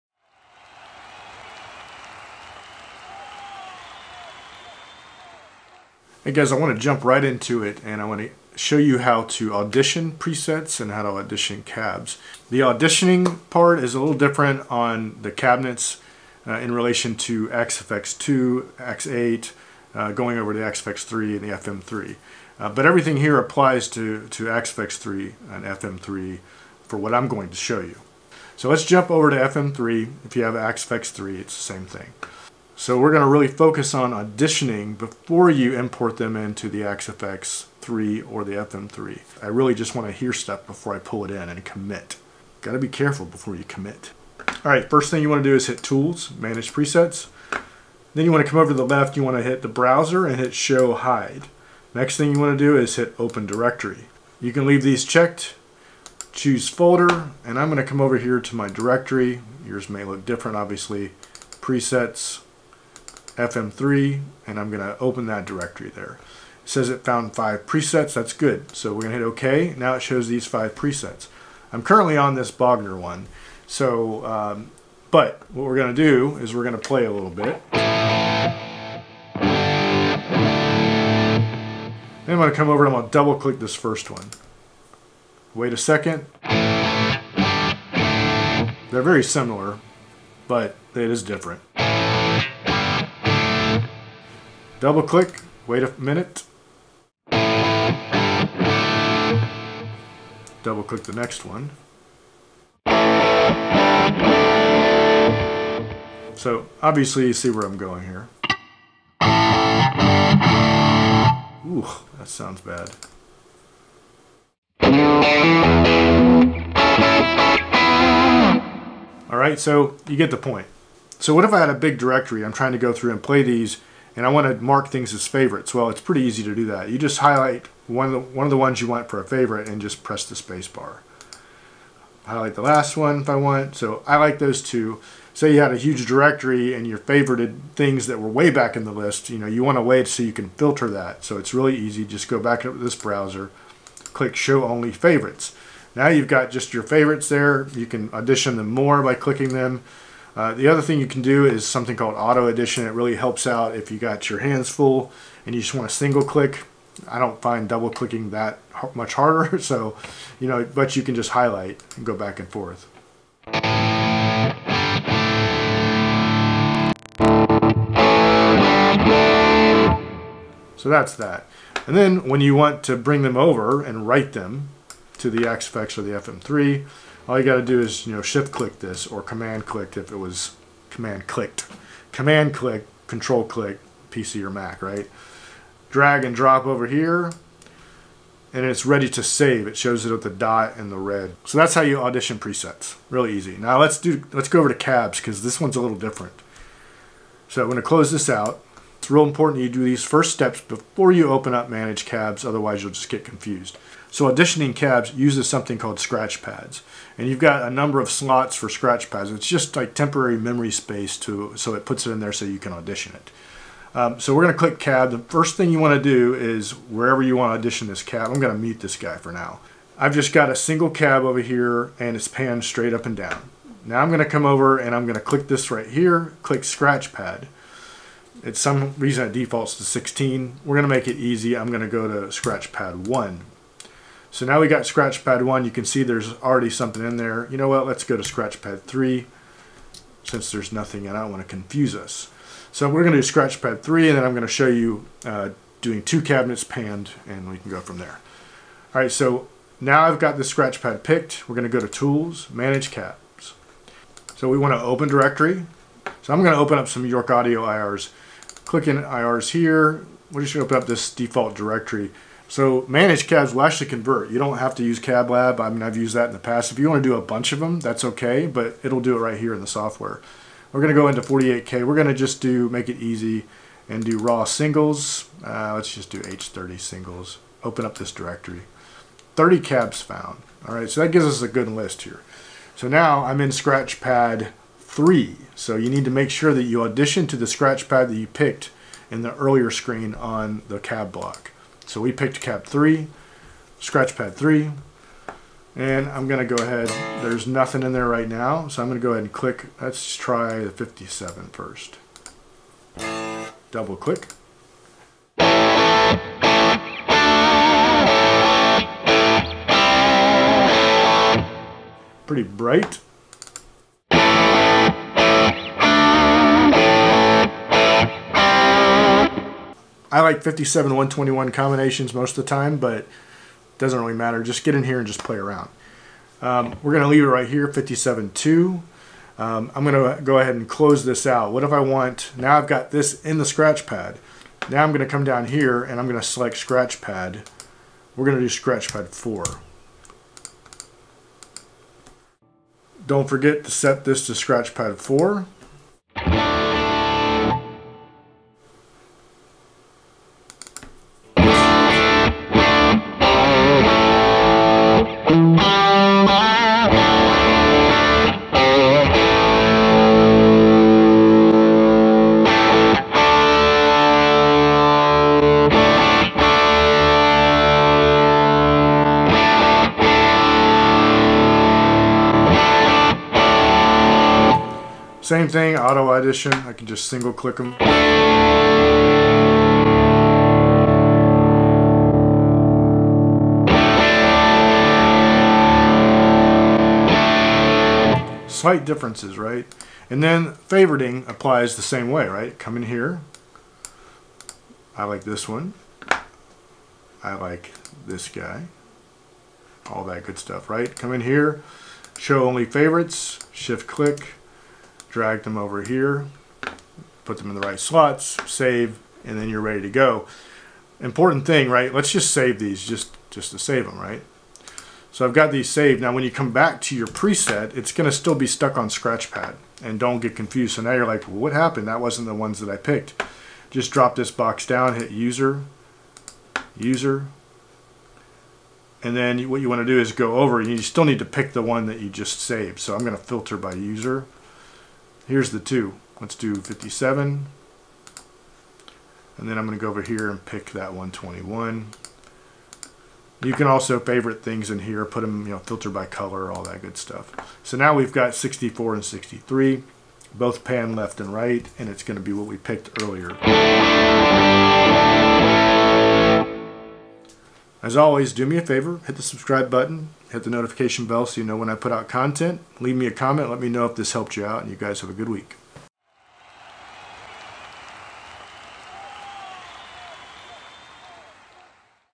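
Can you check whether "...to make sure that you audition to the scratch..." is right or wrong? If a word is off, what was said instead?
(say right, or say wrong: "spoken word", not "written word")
right.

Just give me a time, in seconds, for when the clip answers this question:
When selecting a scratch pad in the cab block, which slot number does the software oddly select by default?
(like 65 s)
229 s.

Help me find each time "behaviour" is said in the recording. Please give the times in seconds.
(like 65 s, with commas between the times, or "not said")
not said.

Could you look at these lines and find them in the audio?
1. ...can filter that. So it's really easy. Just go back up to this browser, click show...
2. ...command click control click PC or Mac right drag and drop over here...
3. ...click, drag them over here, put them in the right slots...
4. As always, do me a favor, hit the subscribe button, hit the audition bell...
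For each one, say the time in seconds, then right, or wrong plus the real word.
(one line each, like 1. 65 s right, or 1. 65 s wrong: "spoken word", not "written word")
1. 140 s right
2. 182 s right
3. 403 s right
4. 457 s wrong: "notification", not "audition".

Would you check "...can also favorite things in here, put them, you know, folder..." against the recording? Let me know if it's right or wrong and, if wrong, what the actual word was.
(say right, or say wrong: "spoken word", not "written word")
wrong: "filter", not "folder".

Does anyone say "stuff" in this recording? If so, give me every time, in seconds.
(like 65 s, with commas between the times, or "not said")
40 s, 400 s, 446 s.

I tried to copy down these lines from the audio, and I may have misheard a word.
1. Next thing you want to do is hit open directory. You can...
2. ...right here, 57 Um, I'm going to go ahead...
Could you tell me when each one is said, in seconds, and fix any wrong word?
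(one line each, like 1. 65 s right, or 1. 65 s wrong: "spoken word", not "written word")
1. 51 s right
2. 327 s right.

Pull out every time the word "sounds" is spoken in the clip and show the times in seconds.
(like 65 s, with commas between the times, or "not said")
112 s.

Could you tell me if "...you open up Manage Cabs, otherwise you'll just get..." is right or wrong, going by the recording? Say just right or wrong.
right.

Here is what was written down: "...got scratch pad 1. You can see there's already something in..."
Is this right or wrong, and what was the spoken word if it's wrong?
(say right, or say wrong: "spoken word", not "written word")
right.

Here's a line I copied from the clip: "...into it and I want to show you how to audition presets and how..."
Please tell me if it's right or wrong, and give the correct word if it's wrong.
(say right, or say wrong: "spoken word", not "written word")
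right.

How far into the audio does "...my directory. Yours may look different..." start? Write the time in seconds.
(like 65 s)
58 s.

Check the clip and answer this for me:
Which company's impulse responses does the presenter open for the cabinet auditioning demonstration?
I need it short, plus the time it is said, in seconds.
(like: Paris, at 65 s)
York Audio, at 257 s.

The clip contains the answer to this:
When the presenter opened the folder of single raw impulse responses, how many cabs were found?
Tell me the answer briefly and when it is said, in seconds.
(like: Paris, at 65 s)
30, at 279 s.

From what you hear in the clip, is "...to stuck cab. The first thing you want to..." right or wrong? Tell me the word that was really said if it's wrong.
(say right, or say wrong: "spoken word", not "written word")
wrong: "click", not "stuck".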